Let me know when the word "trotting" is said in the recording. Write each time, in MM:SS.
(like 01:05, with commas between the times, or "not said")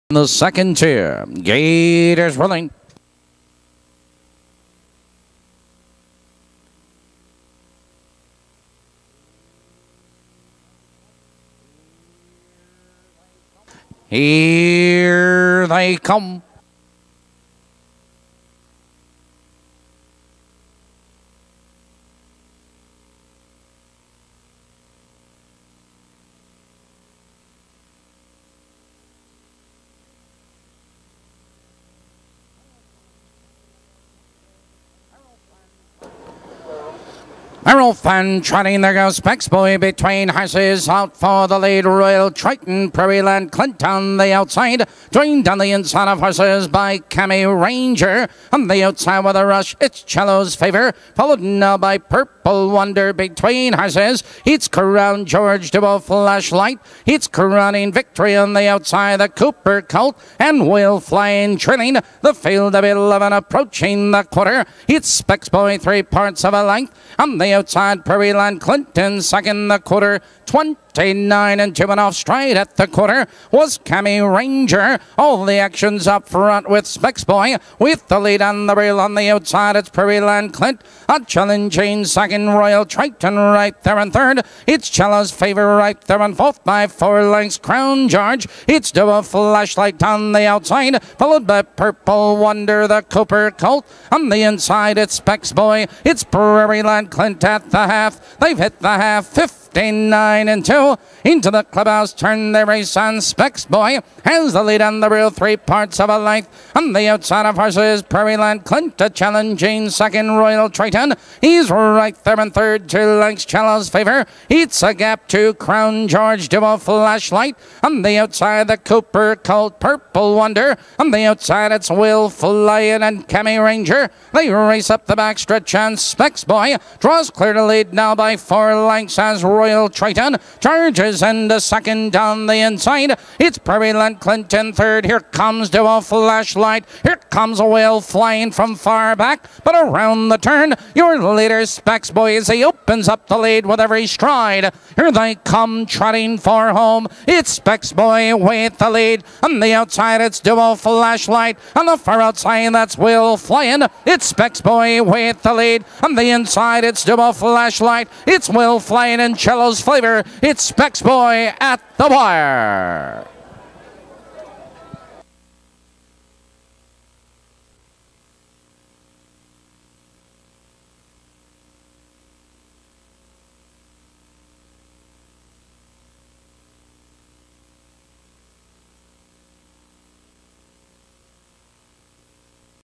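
00:38, 02:25.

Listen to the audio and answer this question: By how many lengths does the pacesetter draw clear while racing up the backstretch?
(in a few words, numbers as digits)
4.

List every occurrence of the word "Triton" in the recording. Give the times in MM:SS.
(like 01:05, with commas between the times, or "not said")
00:42, 01:22, 01:50, 02:09.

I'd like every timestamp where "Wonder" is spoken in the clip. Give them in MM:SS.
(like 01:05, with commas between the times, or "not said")
00:52, 01:32, 02:00.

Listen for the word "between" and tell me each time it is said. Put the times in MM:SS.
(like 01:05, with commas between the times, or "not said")
00:39, 00:53.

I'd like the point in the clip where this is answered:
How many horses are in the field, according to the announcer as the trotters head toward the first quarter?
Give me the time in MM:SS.
01:02.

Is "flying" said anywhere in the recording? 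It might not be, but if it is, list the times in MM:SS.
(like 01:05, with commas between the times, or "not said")
01:00, 02:18, 02:33, 02:38.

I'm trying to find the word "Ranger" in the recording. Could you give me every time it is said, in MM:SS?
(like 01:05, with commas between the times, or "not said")
00:47, 01:14, 02:03.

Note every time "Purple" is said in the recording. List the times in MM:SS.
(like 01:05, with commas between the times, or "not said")
00:51, 01:31, 01:59.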